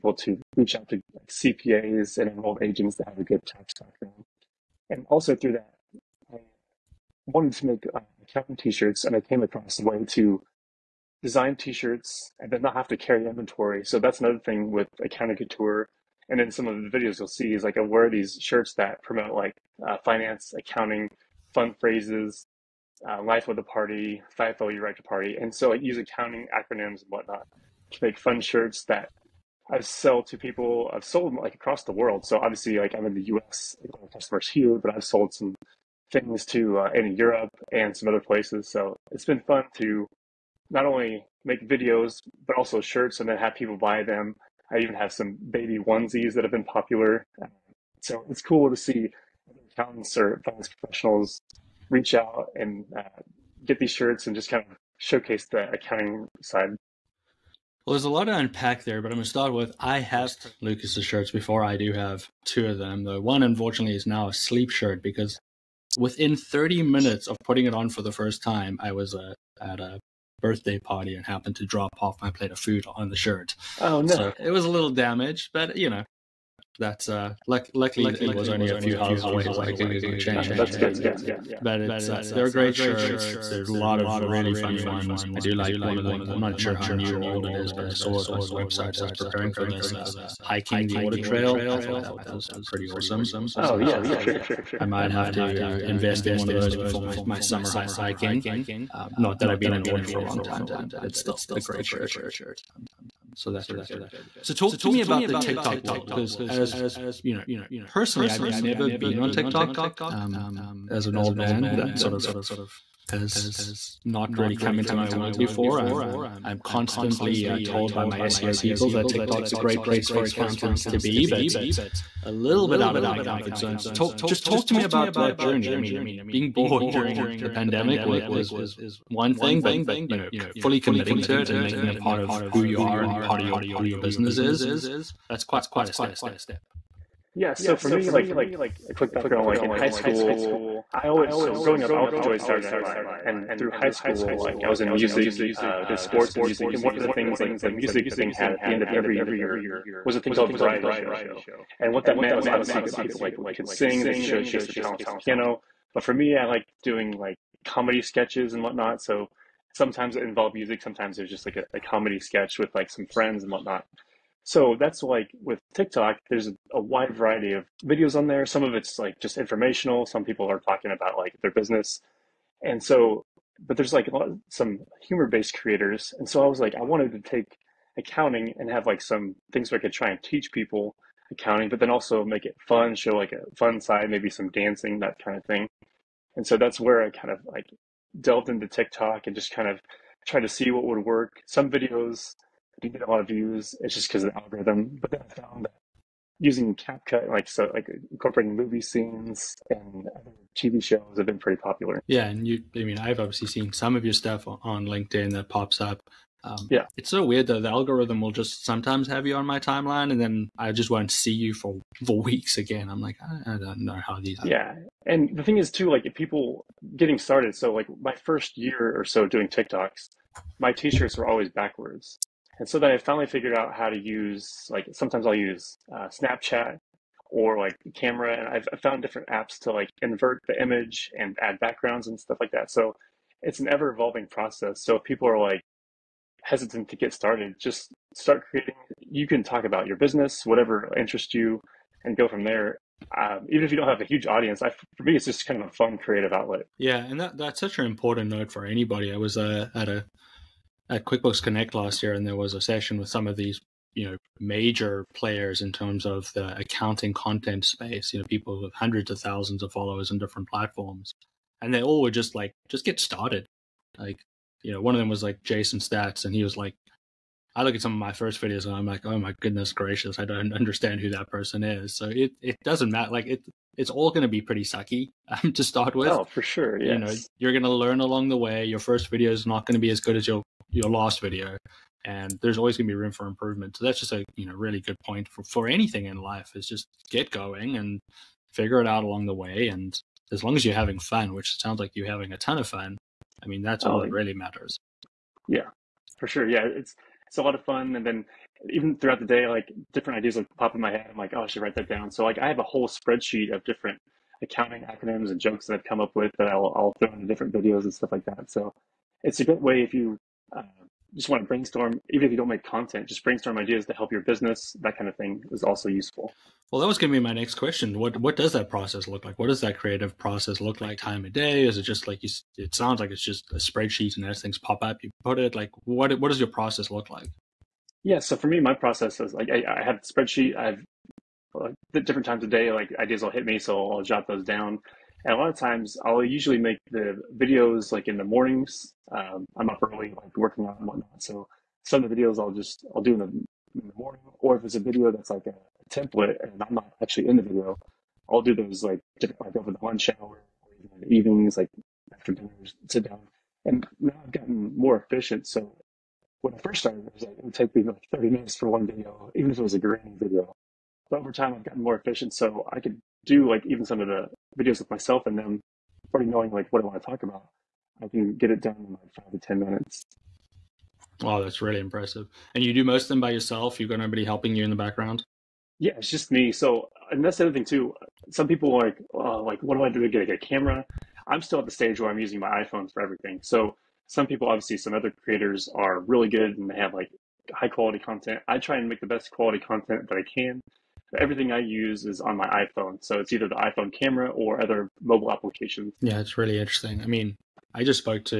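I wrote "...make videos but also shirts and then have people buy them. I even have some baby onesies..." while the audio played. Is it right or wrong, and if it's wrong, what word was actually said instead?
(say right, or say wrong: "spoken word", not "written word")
right.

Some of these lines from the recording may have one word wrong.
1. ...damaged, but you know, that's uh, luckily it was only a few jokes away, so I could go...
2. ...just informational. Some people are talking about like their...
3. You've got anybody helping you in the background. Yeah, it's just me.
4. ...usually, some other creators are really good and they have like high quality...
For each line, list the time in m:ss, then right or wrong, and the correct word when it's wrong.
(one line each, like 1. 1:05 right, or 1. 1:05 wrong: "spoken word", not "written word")
1. 1:14 wrong: "houses", not "jokes"
2. 2:49 right
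3. 6:13 wrong: "nobody", not "anybody"
4. 6:24 wrong: "obviously", not "usually".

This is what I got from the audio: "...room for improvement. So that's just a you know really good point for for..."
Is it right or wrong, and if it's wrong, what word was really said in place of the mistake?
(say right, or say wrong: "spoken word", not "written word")
right.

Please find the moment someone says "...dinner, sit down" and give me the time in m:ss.
5:52.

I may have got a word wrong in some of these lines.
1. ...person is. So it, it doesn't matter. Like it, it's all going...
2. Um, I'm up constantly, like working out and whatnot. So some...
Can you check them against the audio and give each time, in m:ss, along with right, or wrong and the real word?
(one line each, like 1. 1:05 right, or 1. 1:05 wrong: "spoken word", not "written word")
1. 4:31 right
2. 5:39 wrong: "early", not "constantly".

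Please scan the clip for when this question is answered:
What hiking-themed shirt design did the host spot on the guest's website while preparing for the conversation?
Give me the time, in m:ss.
1:30.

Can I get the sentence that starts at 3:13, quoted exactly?
It's just because of the algorithm.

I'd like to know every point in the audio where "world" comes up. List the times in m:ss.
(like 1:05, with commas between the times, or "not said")
0:31, 1:45, 1:55.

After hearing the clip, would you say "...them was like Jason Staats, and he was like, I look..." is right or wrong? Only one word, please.
right.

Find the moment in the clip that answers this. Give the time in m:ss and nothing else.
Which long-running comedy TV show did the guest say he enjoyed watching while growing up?
2:22.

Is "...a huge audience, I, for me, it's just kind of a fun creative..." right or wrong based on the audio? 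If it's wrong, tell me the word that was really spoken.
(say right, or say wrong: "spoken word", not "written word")
right.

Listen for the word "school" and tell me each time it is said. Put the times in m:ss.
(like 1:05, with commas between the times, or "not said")
2:19, 2:23.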